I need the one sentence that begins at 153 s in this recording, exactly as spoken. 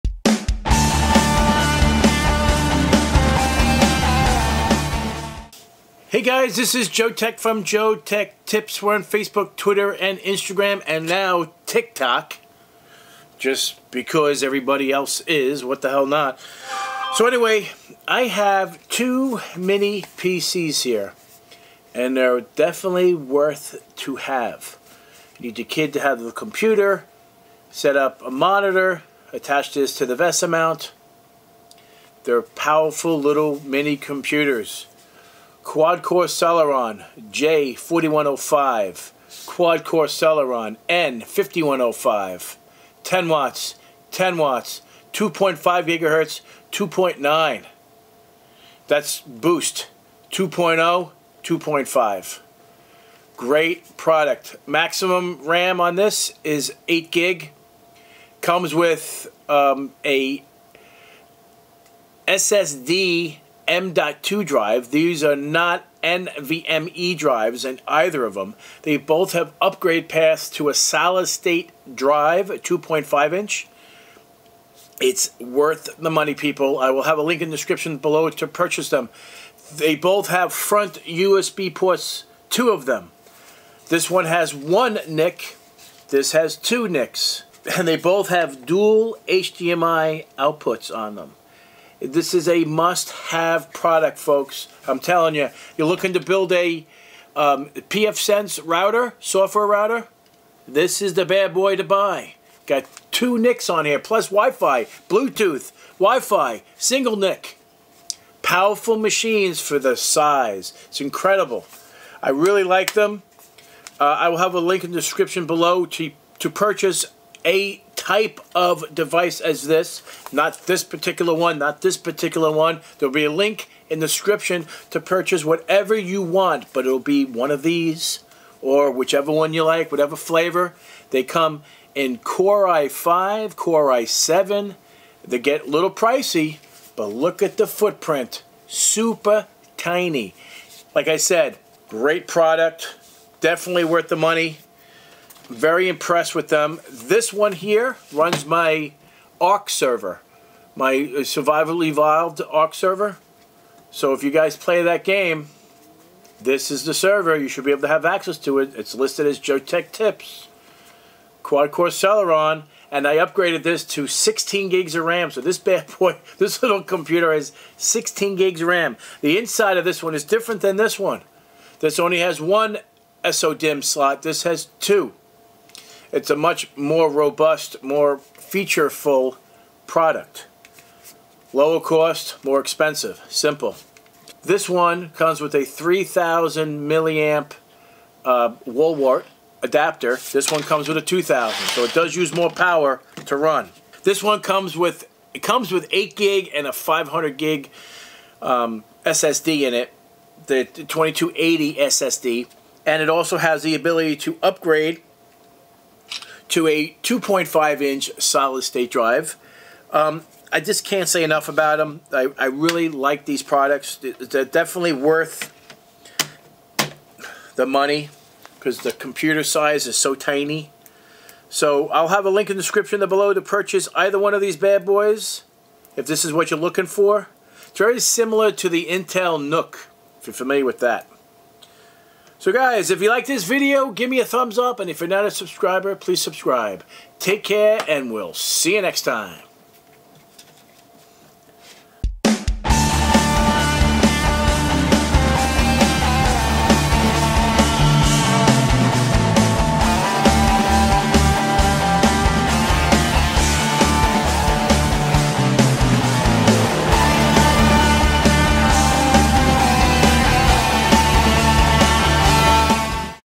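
So if you guys play that game, this is the server.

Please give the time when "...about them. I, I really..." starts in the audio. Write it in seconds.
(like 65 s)
211 s.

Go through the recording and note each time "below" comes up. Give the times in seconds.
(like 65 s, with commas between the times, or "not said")
77 s, 115 s, 222 s.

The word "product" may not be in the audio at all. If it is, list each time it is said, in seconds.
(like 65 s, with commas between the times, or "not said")
53 s, 93 s, 142 s, 179 s, 213 s.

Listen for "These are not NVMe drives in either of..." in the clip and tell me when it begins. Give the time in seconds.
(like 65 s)
64 s.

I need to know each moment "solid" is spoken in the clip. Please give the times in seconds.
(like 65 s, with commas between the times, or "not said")
70 s, 208 s.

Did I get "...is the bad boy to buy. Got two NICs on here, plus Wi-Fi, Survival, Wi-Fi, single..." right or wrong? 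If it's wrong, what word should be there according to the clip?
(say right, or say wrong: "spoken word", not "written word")
wrong: "Bluetooth", not "Survival".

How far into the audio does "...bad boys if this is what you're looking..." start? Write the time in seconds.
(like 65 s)
224 s.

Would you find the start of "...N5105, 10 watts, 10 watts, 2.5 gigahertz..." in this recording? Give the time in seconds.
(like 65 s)
40 s.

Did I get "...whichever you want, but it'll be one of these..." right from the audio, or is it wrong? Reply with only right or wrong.
wrong.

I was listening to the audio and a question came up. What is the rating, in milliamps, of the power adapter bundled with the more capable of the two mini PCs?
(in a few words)
3000 milliamp.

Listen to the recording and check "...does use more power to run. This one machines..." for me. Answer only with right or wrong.
wrong.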